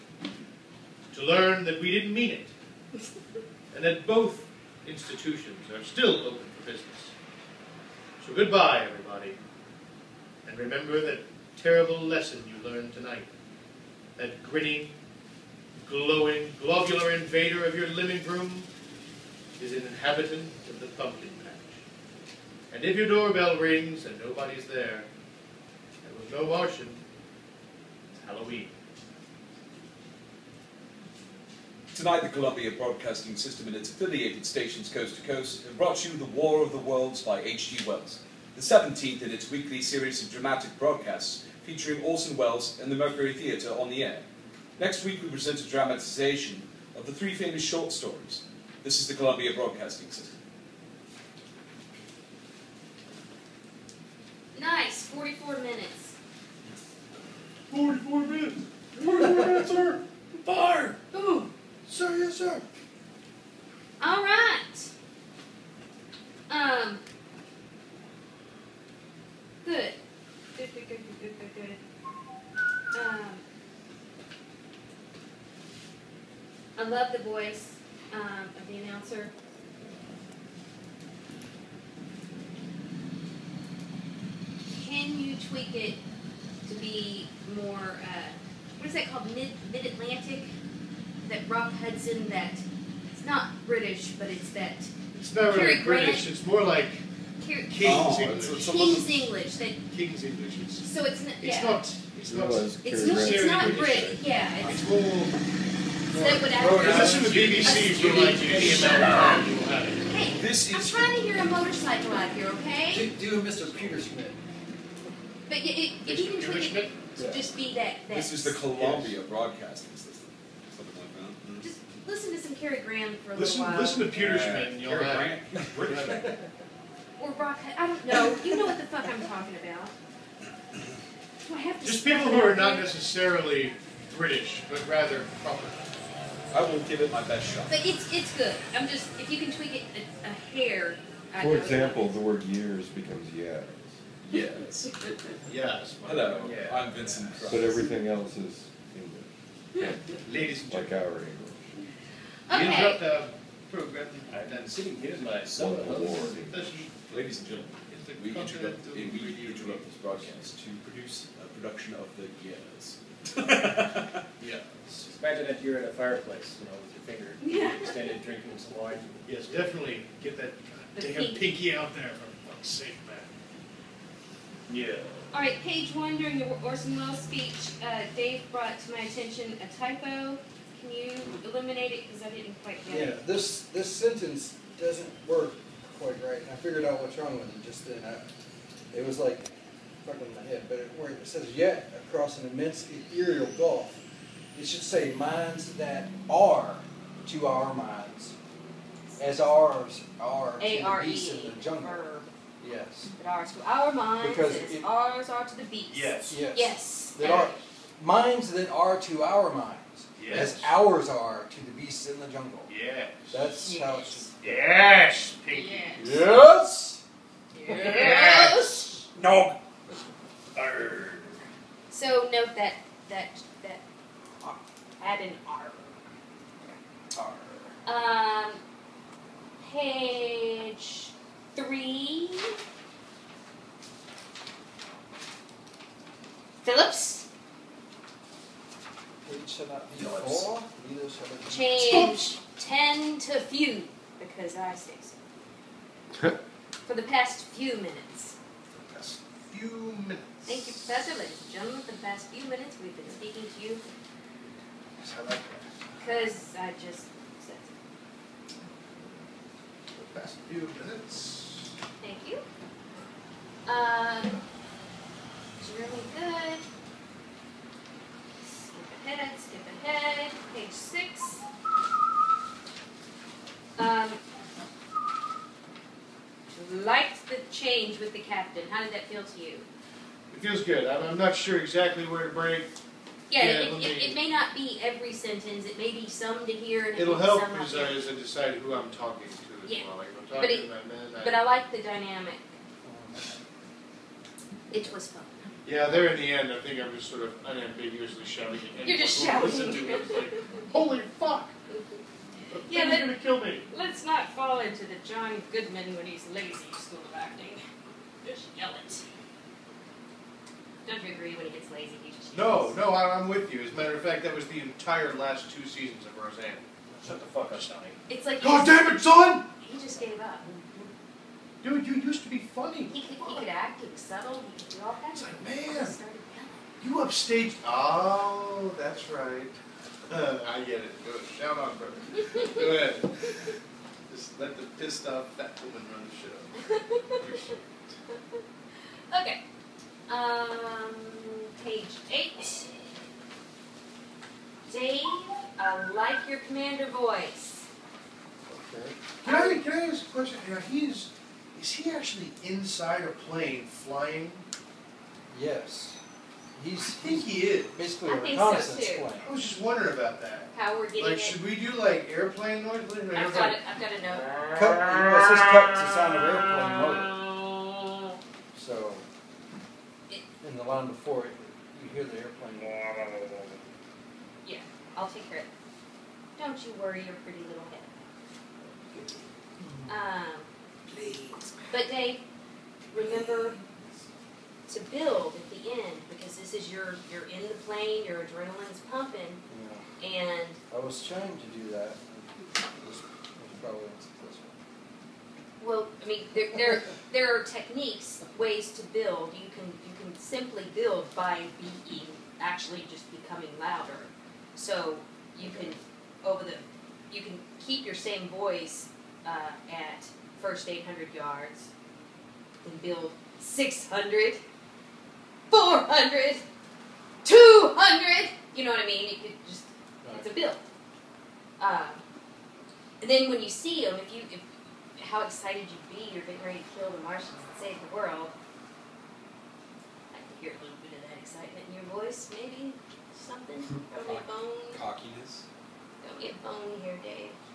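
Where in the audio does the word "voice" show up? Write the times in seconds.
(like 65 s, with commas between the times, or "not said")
77 s, 346 s, 408 s, 431 s.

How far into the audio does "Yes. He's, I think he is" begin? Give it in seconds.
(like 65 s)
355 s.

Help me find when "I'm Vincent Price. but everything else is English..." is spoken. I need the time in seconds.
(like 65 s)
146 s.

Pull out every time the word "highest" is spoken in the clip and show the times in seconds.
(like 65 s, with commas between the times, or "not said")
not said.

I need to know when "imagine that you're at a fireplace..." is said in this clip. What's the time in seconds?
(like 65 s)
165 s.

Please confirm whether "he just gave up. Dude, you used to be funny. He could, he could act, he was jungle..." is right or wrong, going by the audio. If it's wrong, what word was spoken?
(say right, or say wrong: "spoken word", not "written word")
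wrong: "subtle", not "jungle".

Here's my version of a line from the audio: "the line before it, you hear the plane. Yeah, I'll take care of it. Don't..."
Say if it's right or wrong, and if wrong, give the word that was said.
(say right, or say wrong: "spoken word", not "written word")
wrong: "airplane", not "plane".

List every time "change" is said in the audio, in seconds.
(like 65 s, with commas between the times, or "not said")
241 s, 277 s.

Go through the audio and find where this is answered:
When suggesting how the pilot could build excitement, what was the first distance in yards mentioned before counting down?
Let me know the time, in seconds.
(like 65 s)
410 s.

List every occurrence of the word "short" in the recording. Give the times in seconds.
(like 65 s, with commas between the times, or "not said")
47 s.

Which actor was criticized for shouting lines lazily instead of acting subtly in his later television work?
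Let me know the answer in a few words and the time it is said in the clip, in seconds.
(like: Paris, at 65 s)
John Goodman, at 305 s.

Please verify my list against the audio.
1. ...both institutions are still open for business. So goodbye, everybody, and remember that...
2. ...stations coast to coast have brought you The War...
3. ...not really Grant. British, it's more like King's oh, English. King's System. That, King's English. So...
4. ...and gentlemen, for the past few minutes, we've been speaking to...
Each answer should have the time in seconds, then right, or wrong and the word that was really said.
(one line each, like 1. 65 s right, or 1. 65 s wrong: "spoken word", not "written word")
1. 4 s right
2. 34 s right
3. 95 s wrong: "English", not "System"
4. 251 s right.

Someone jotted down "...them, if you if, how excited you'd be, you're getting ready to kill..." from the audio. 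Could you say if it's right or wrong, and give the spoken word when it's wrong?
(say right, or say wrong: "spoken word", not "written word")
right.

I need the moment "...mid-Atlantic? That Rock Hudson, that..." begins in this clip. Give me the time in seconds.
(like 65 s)
89 s.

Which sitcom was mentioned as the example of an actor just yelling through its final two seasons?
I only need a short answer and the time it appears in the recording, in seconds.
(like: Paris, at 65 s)
Roseanne, at 316 s.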